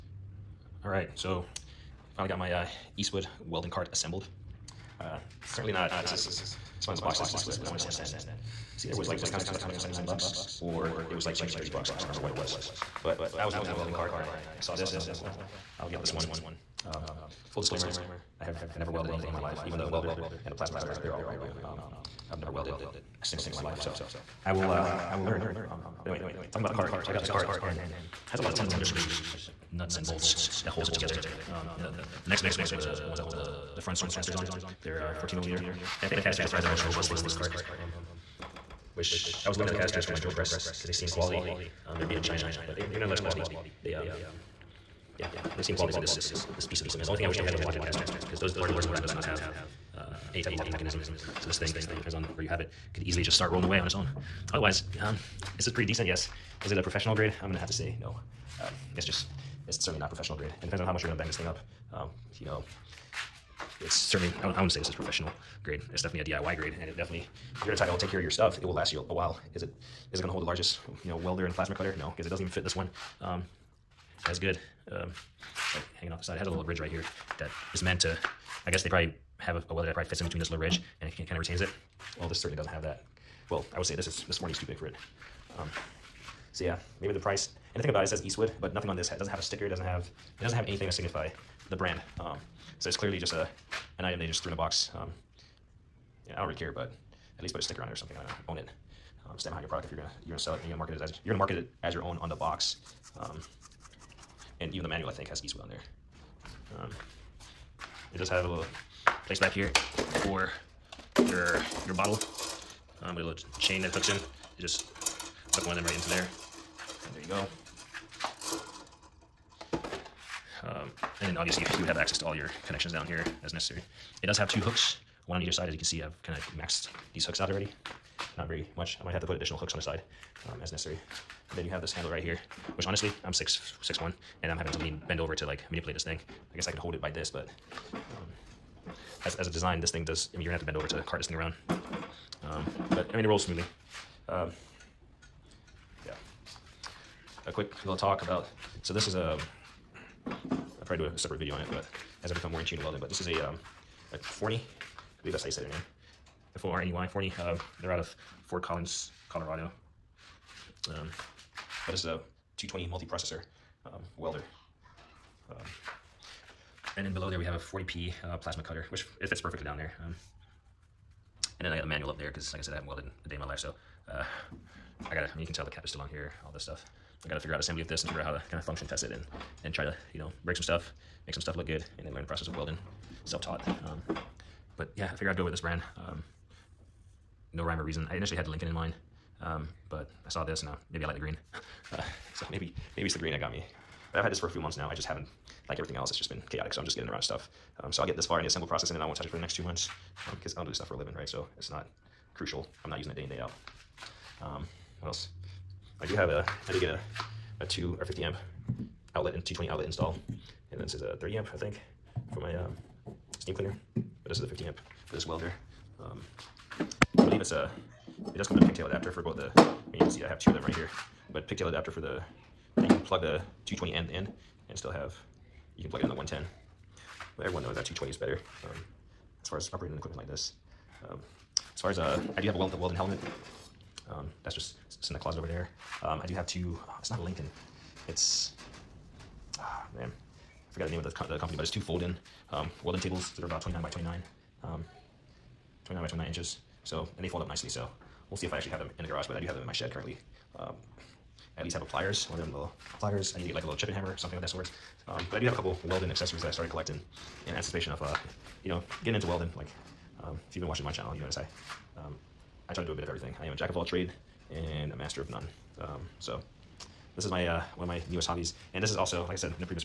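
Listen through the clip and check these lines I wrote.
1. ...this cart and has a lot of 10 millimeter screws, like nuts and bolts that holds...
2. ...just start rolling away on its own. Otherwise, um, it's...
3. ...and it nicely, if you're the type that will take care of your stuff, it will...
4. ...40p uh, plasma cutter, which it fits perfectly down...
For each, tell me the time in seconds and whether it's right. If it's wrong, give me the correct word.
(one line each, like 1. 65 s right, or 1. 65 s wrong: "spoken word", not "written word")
1. 27 s right
2. 53 s right
3. 66 s wrong: "definitely", not "nicely"
4. 167 s right.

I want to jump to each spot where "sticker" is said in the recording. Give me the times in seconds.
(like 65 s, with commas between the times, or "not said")
89 s, 97 s.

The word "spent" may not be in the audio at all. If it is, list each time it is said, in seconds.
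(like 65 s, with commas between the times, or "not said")
7 s.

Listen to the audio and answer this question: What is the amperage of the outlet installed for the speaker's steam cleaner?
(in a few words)
30 amp.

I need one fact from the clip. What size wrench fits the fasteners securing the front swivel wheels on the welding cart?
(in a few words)
14 millimeter.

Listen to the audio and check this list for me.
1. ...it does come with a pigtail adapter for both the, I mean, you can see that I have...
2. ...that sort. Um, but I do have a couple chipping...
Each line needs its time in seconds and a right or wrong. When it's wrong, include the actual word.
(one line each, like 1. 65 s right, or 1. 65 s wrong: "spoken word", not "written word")
1. 218 s right
2. 254 s wrong: "welding", not "chipping".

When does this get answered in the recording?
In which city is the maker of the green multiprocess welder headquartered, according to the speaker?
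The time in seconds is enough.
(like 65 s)
158 s.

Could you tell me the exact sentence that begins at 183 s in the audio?
Um, but yeah, I figure I'd go with this brand.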